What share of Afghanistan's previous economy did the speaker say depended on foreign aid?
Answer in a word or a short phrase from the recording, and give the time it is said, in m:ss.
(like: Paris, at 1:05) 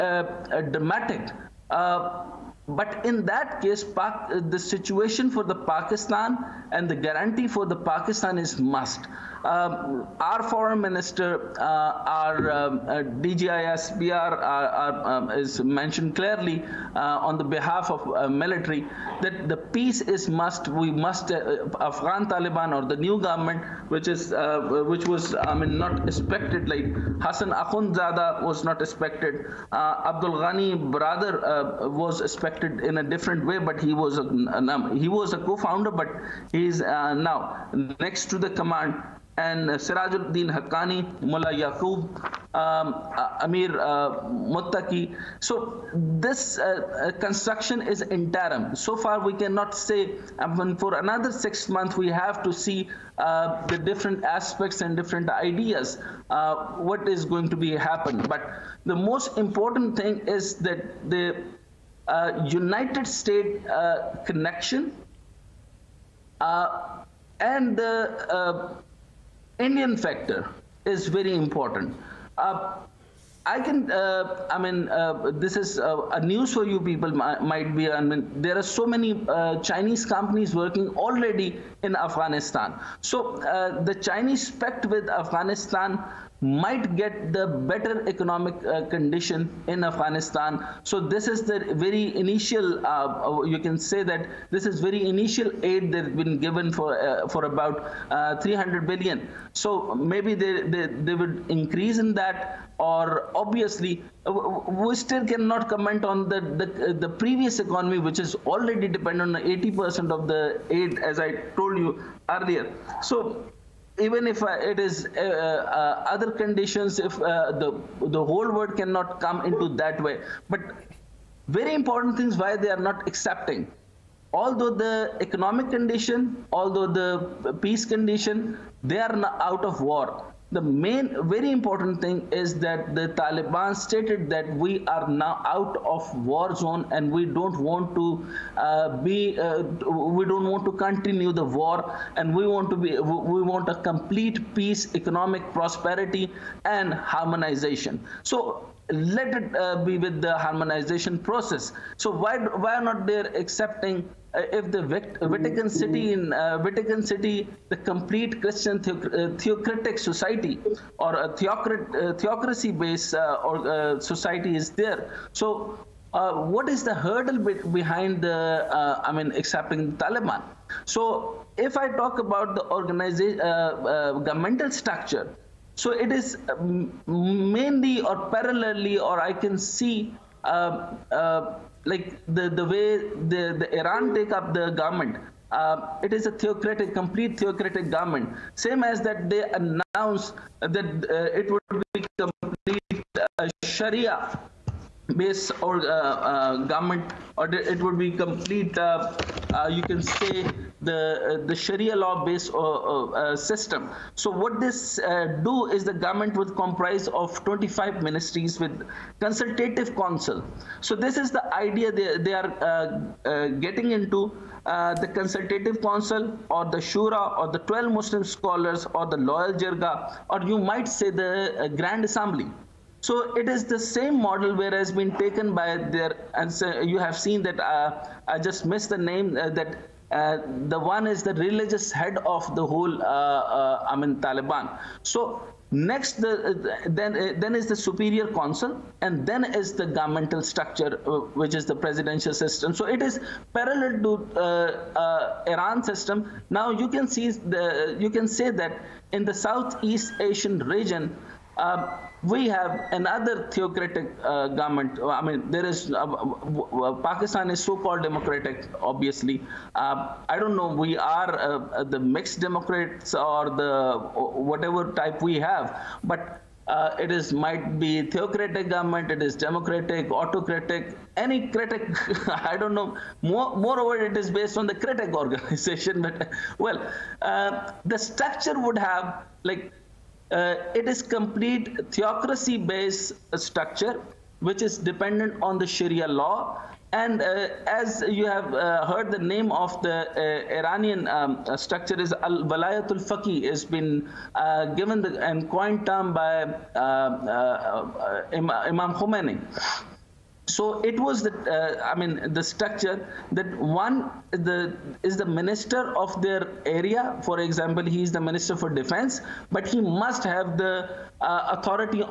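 80%, at 1:49.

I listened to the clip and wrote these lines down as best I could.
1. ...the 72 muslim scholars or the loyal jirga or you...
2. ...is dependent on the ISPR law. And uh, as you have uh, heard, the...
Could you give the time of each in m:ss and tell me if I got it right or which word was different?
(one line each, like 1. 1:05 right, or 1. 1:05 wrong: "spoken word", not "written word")
1. 3:37 wrong: "12", not "72"
2. 4:44 wrong: "Sharia", not "ISPR".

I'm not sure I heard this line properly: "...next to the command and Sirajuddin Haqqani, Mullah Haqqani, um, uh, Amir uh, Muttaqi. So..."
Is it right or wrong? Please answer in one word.
wrong.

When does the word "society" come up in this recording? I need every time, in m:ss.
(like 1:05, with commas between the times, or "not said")
2:39, 2:44.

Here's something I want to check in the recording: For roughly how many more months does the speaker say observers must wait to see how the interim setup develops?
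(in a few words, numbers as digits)
6.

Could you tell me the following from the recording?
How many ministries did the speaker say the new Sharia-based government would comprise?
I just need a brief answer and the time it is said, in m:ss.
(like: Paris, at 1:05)
25, at 3:27.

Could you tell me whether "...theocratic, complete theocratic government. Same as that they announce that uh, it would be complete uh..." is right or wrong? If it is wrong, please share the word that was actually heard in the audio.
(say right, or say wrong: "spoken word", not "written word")
right.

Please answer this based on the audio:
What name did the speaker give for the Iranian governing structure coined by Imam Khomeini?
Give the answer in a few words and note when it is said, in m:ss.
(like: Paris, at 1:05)
Al Walayatul Faqih, at 4:52.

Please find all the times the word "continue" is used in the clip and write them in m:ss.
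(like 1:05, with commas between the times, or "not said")
2:20.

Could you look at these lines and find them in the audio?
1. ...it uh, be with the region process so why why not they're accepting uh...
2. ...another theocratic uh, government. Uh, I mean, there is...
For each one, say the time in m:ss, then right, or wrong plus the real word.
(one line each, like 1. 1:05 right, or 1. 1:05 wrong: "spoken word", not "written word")
1. 2:29 wrong: "harmonization", not "region"
2. 4:12 right.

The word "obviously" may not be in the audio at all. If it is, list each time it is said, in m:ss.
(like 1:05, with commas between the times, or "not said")
1:43, 4:18.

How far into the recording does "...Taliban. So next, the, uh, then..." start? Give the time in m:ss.
3:54.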